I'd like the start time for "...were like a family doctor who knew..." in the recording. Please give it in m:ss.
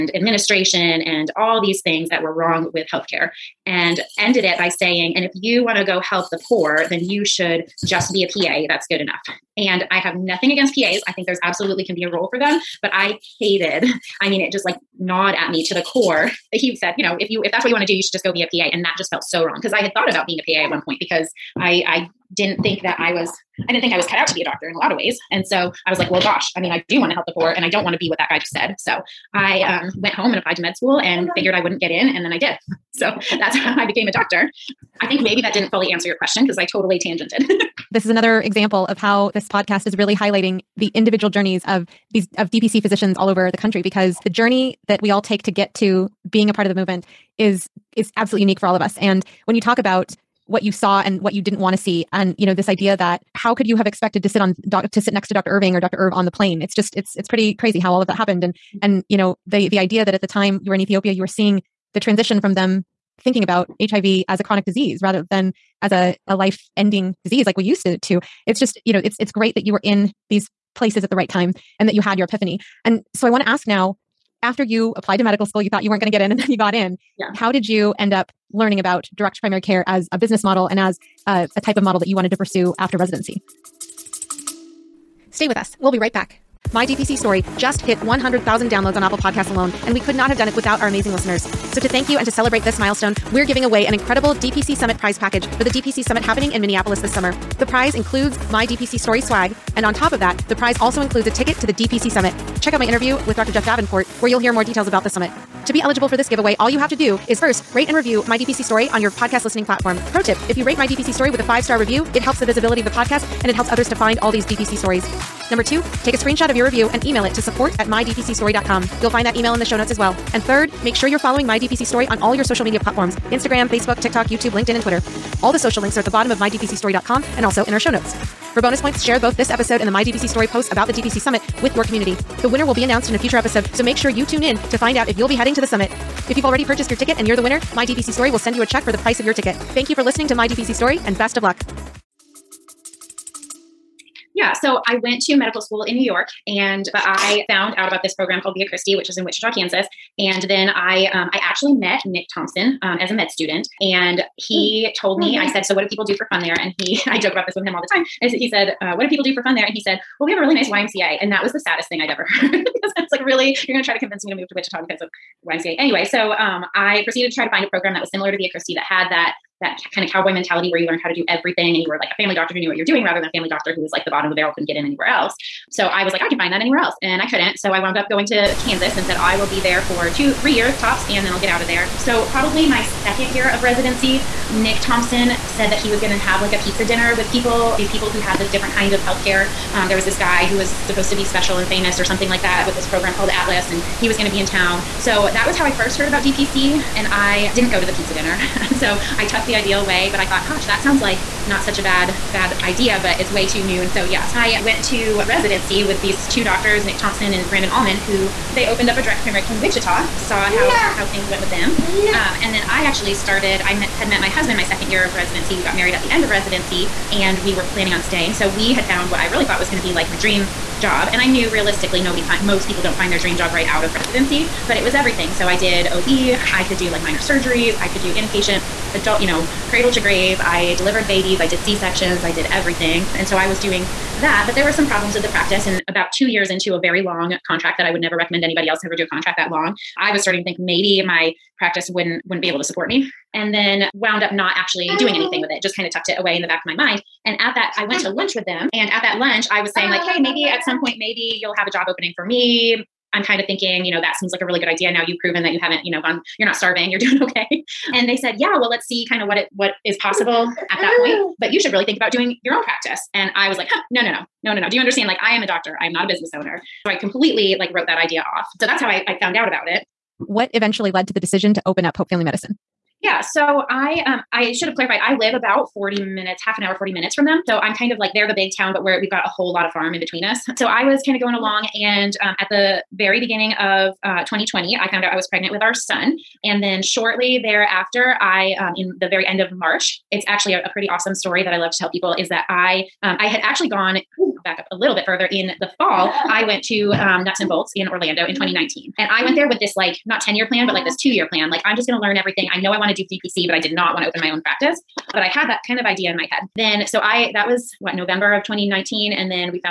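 2:51.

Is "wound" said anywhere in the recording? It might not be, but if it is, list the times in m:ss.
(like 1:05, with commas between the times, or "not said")
2:57, 4:03.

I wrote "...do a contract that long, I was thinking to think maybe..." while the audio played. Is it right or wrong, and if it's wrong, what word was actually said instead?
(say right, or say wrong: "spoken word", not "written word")
wrong: "starting", not "thinking".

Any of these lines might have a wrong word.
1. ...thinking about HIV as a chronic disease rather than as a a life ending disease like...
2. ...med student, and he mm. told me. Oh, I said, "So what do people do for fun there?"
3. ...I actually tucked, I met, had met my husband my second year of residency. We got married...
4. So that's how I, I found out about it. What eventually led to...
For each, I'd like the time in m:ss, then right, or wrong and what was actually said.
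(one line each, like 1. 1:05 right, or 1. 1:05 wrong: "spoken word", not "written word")
1. 1:03 right
2. 2:33 right
3. 3:32 wrong: "started", not "tucked"
4. 4:28 right.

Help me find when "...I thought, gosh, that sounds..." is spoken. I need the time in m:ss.
3:20.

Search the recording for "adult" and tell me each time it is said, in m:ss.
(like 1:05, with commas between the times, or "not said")
3:48.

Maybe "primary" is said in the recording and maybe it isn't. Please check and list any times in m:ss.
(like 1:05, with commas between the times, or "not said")
1:19, 3:29.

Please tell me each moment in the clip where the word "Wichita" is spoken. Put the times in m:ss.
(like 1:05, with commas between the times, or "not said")
2:29, 2:44, 3:29.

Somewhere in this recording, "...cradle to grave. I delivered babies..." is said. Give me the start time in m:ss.
3:49.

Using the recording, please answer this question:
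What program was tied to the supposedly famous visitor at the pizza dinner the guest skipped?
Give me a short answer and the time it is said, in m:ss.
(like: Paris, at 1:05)
Atlas, at 3:13.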